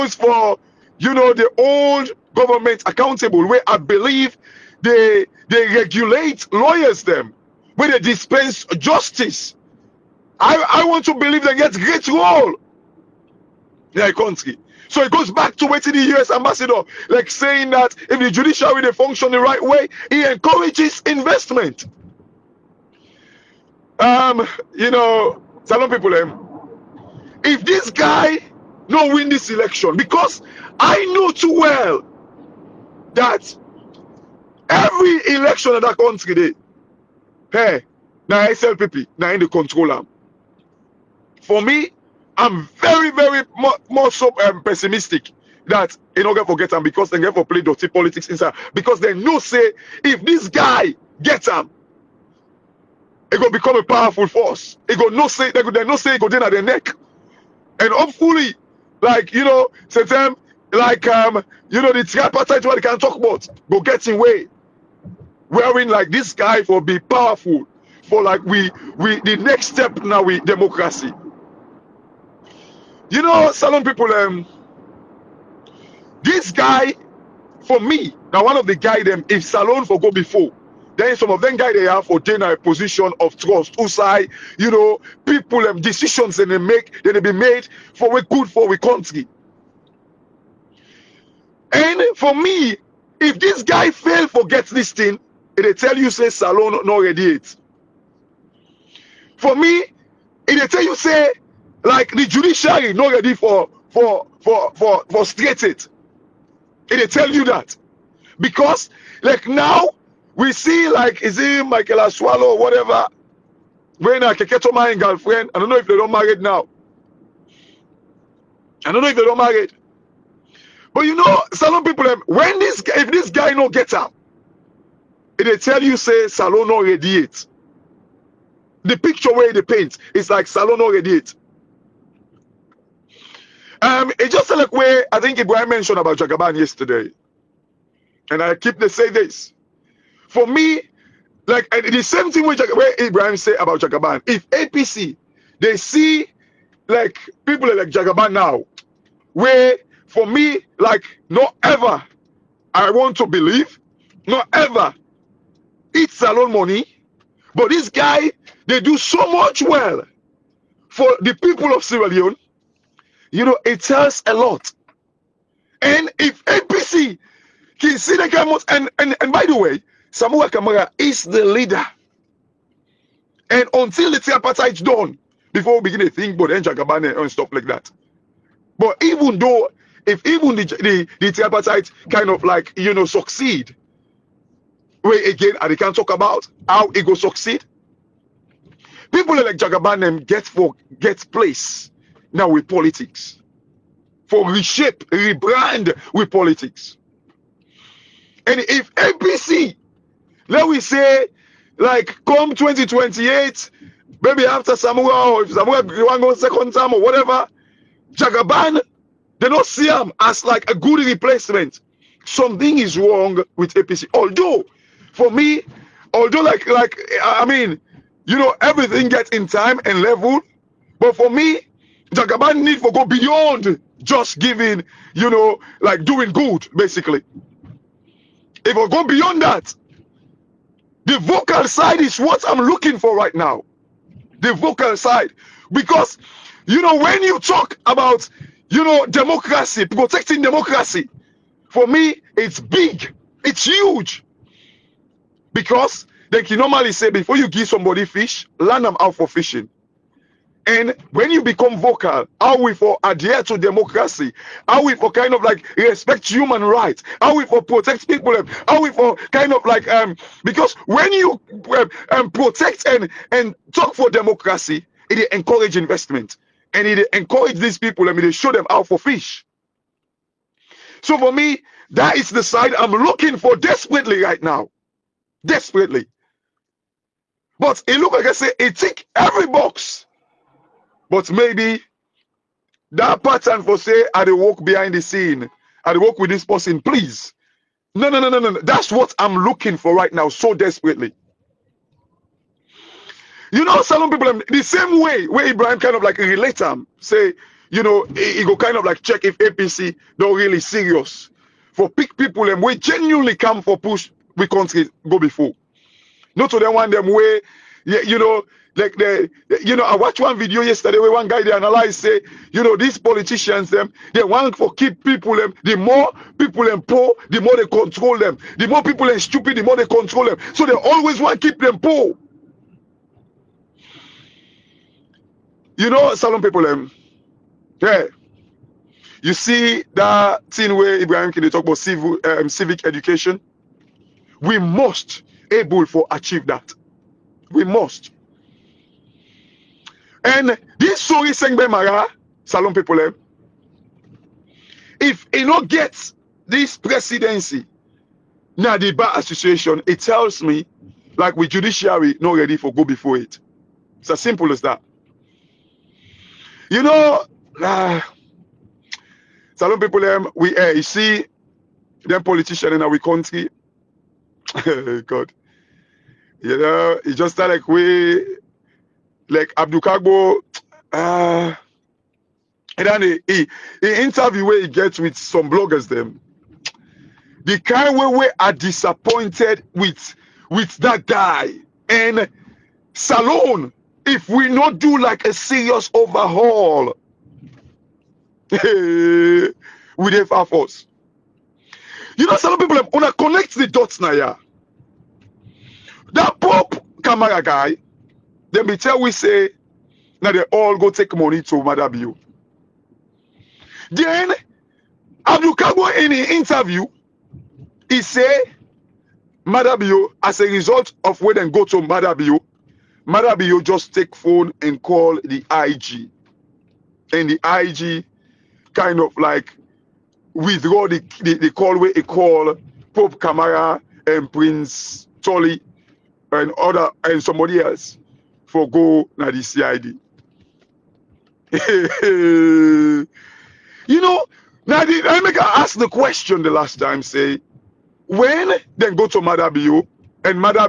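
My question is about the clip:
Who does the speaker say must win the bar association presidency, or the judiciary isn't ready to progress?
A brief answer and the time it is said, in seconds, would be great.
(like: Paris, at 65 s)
Sorie Sengbe Marrah, at 341 s.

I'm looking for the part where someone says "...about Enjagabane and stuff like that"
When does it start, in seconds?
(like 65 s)
176 s.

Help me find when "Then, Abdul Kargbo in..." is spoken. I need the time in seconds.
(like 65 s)
403 s.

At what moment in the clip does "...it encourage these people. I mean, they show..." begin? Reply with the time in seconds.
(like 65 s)
266 s.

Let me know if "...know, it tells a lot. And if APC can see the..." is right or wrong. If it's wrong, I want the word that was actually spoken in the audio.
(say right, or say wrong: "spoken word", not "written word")
right.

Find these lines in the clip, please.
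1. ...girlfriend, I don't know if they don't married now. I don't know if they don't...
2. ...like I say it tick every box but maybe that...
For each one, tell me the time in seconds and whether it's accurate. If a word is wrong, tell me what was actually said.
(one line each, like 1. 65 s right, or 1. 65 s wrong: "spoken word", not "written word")
1. 114 s right
2. 278 s right.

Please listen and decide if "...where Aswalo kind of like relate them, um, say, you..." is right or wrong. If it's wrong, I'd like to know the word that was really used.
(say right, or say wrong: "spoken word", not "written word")
wrong: "Ibrahim", not "Aswalo".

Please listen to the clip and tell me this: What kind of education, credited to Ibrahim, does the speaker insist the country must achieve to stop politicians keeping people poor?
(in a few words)
civic education.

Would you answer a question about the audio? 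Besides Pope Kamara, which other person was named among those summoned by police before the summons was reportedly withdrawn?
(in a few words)
Prince Tolly.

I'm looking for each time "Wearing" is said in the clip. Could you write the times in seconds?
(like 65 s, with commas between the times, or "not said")
65 s.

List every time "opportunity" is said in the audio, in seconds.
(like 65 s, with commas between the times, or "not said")
not said.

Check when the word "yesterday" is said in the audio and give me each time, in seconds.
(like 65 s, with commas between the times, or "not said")
136 s, 310 s.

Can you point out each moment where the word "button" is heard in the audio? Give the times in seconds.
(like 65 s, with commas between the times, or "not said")
not said.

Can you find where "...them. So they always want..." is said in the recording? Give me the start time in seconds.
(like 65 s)
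320 s.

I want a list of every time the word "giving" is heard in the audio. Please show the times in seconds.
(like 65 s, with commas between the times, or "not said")
224 s.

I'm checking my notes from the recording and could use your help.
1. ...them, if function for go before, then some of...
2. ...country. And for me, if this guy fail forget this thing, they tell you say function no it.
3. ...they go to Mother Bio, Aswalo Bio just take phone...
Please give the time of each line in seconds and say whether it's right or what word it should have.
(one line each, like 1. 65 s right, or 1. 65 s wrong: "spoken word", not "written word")
1. 79 s wrong: "salon", not "function"
2. 88 s wrong: "salon", not "function"
3. 411 s wrong: "Mother", not "Aswalo".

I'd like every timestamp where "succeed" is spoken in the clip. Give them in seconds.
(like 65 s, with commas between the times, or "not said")
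183 s, 187 s.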